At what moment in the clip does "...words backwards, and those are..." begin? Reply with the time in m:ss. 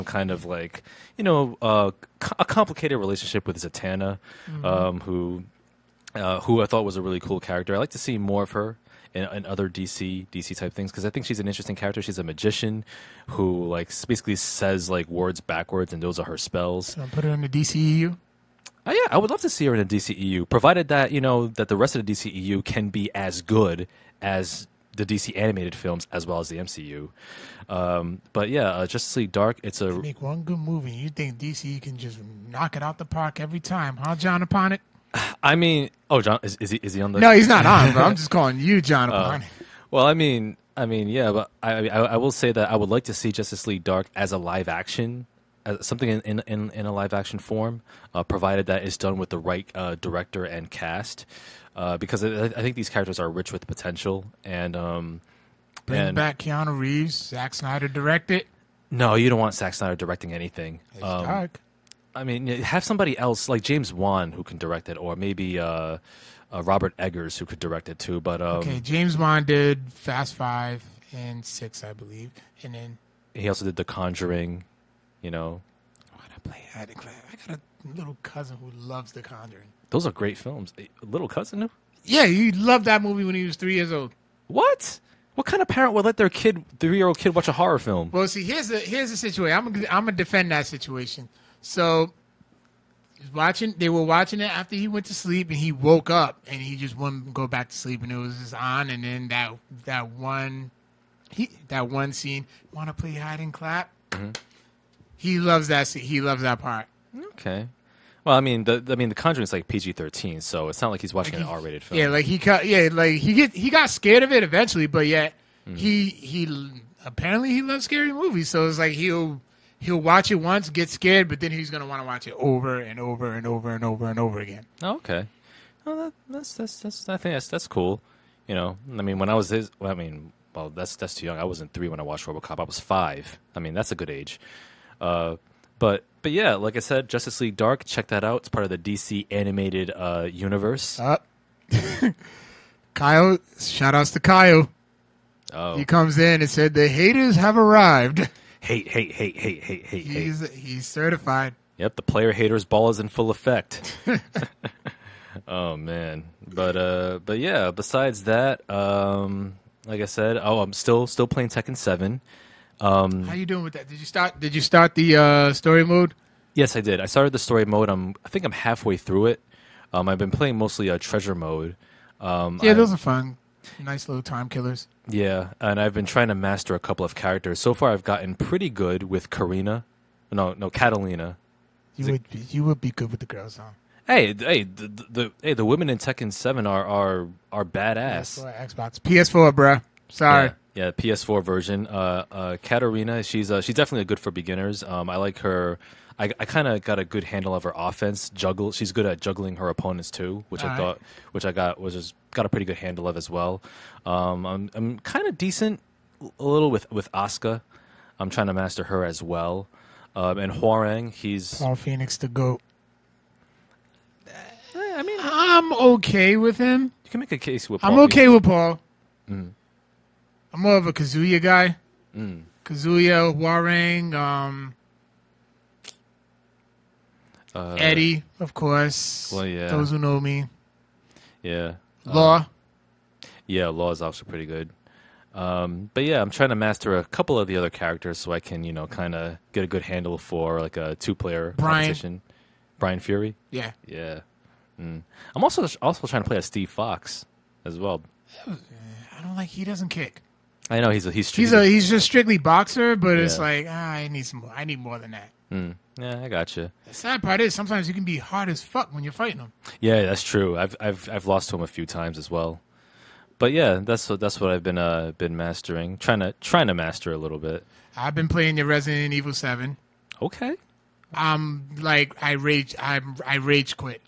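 0:15.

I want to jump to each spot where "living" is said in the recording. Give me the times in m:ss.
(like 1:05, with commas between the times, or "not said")
not said.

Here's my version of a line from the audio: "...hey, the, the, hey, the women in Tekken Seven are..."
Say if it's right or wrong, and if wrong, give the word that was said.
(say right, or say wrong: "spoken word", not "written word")
right.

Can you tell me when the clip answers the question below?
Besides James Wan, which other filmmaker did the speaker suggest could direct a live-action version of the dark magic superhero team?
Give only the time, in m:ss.
1:06.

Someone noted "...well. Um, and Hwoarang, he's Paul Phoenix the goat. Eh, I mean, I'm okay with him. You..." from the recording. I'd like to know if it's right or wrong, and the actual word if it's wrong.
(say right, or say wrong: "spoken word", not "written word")
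right.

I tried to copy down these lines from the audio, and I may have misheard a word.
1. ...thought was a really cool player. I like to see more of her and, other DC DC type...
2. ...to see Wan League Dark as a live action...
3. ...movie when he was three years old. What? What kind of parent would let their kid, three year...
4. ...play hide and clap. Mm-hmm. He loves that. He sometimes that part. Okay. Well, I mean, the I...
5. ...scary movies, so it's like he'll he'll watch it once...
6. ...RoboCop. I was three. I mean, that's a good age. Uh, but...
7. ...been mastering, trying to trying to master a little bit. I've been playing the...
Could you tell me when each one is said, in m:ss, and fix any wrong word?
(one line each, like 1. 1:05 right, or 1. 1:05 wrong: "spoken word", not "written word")
1. 0:06 wrong: "character", not "player"
2. 0:43 wrong: "Justice", not "Wan"
3. 1:23 right
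4. 1:42 wrong: "loves", not "sometimes"
5. 1:57 right
6. 2:12 wrong: "five", not "three"
7. 4:25 right.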